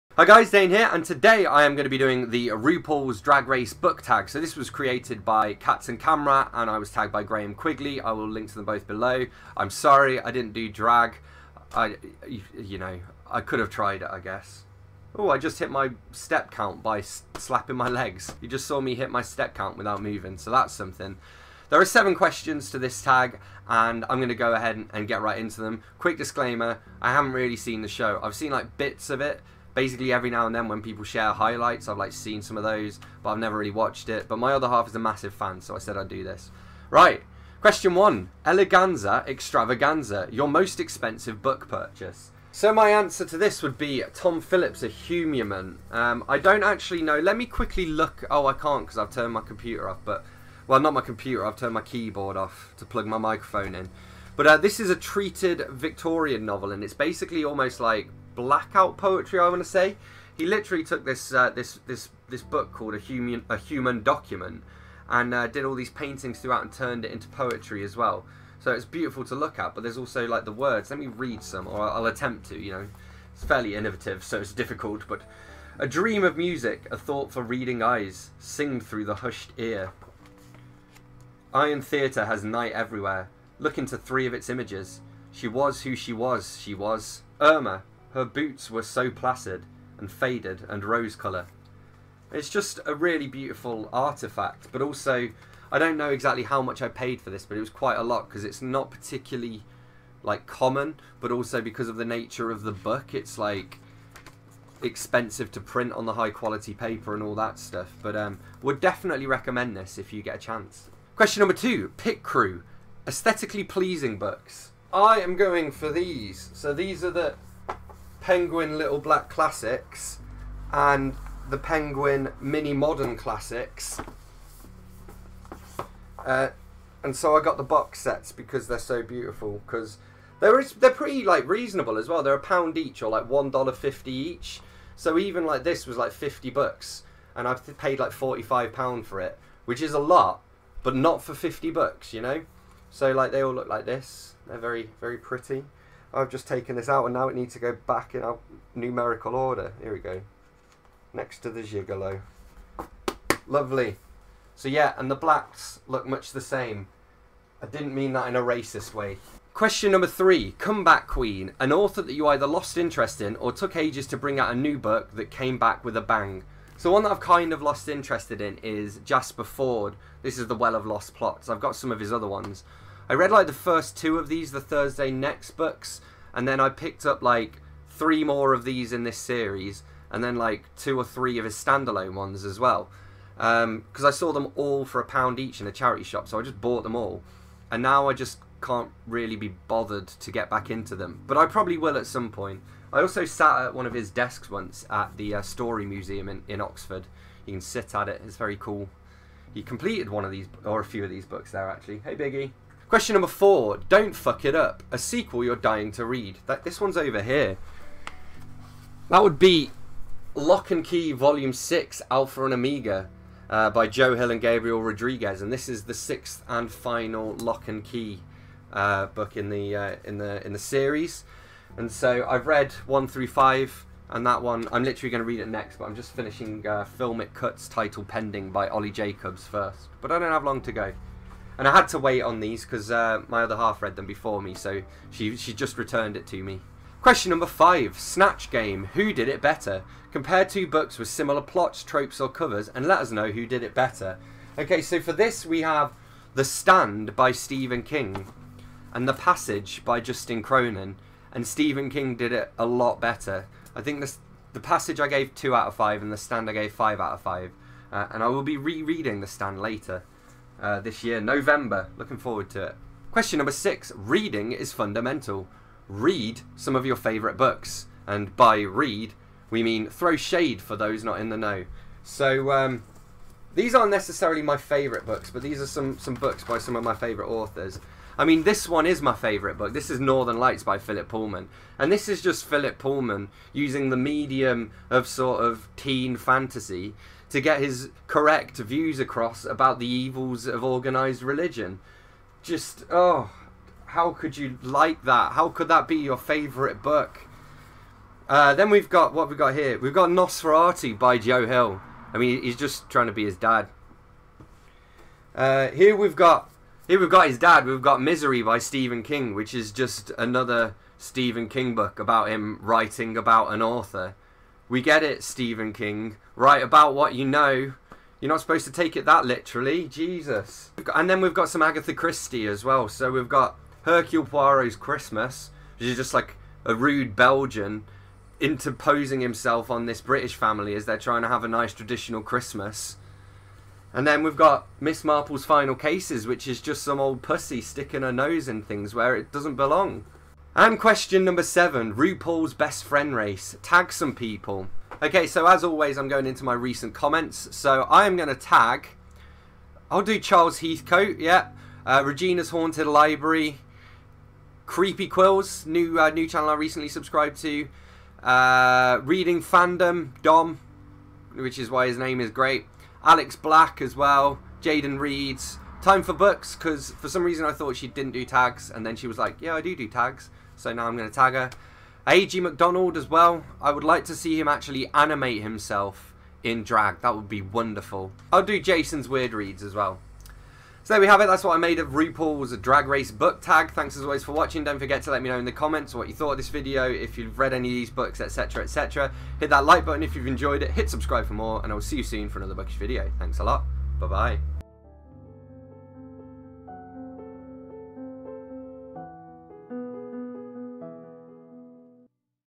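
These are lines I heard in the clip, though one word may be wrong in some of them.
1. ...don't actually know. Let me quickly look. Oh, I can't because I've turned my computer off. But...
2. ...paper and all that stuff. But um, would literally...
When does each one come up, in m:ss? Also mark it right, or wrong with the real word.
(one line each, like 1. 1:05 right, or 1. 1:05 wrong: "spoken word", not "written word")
1. 0:46 right
2. 1:46 wrong: "definitely", not "literally".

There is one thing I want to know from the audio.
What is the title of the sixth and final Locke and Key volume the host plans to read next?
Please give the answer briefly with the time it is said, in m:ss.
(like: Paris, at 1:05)
Alpha and Omega, at 3:32.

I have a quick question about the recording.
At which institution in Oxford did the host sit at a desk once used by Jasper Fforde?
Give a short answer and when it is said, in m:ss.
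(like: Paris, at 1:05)
Story Museum, at 3:15.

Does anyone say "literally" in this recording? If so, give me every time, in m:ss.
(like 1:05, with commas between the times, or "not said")
1:00, 3:44, 5:19.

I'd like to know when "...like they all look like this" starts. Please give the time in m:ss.
2:23.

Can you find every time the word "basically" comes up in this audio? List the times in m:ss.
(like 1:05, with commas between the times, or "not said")
0:29, 0:56.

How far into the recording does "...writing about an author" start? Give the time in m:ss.
5:12.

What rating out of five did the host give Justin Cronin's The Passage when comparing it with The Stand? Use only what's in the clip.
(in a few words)
2.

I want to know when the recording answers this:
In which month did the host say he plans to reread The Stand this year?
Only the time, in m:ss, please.
4:21.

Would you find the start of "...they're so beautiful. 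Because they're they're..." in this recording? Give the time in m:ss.
2:08.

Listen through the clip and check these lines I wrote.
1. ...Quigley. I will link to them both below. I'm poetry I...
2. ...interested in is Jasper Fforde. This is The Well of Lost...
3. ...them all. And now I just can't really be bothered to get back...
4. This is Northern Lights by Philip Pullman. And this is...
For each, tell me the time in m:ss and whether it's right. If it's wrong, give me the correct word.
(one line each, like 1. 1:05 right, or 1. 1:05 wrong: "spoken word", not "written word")
1. 0:07 wrong: "sorry", not "poetry"
2. 2:47 right
3. 3:06 right
4. 4:39 right.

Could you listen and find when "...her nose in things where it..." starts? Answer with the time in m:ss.
5:38.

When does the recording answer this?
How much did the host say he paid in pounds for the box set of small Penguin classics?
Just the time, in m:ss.
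2:18.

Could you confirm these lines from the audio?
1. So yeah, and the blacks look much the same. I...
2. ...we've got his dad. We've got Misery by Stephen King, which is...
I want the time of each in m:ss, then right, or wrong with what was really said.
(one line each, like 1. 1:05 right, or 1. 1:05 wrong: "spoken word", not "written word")
1. 2:34 right
2. 5:06 right.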